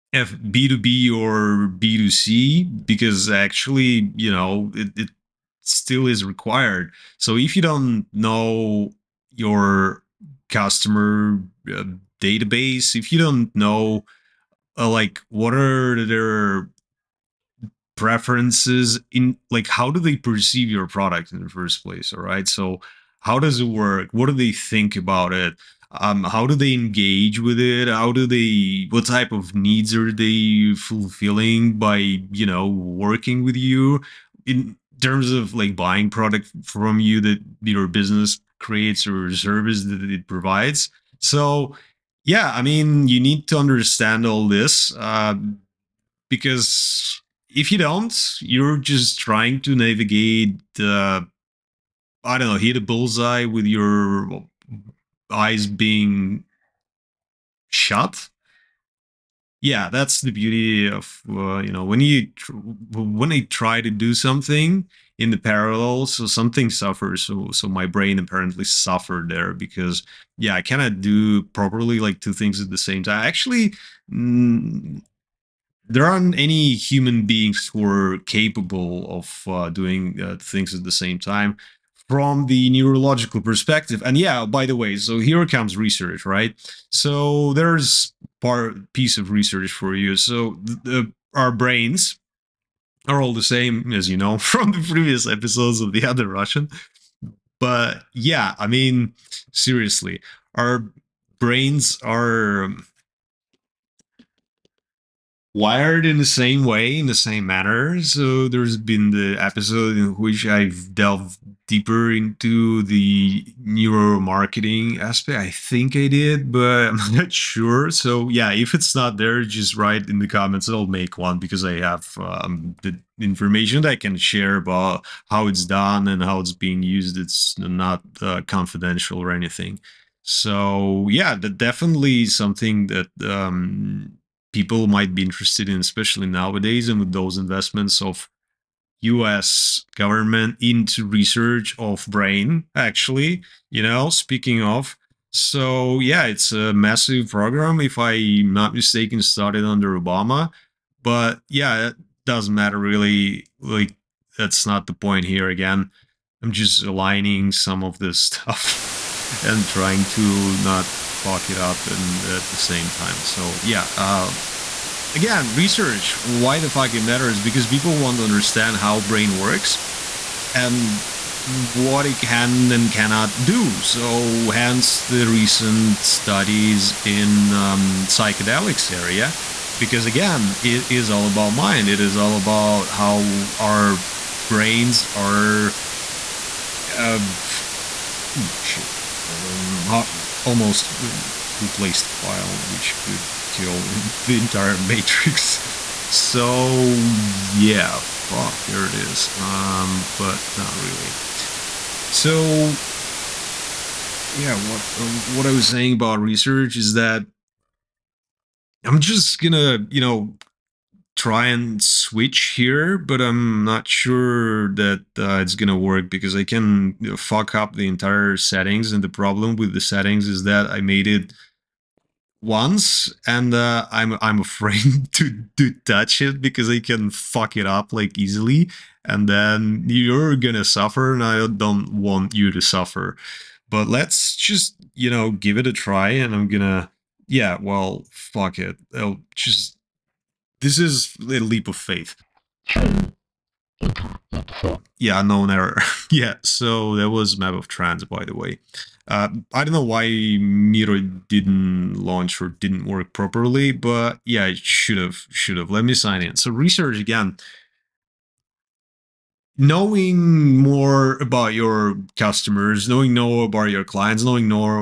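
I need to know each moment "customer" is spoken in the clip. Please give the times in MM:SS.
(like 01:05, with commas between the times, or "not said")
00:10, 04:22.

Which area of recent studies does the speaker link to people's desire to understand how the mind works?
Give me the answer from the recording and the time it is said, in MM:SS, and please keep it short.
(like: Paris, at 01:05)
Psychedelics, at 02:58.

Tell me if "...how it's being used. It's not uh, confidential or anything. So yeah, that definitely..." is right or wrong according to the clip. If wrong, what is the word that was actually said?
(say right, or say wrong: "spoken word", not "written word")
right.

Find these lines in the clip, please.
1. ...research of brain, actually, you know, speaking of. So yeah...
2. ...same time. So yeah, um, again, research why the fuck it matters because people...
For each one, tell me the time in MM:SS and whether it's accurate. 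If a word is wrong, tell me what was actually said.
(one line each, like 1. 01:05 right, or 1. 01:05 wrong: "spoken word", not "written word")
1. 02:21 right
2. 02:42 right.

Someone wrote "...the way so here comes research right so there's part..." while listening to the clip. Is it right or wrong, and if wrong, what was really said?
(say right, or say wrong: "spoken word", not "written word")
right.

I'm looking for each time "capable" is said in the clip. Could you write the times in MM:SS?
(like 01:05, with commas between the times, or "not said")
01:18.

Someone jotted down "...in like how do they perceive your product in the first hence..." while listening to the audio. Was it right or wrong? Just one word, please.
wrong.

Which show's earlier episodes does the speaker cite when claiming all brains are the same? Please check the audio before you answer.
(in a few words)
The Other Russian.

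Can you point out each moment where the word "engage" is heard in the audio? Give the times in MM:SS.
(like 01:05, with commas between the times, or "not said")
00:26.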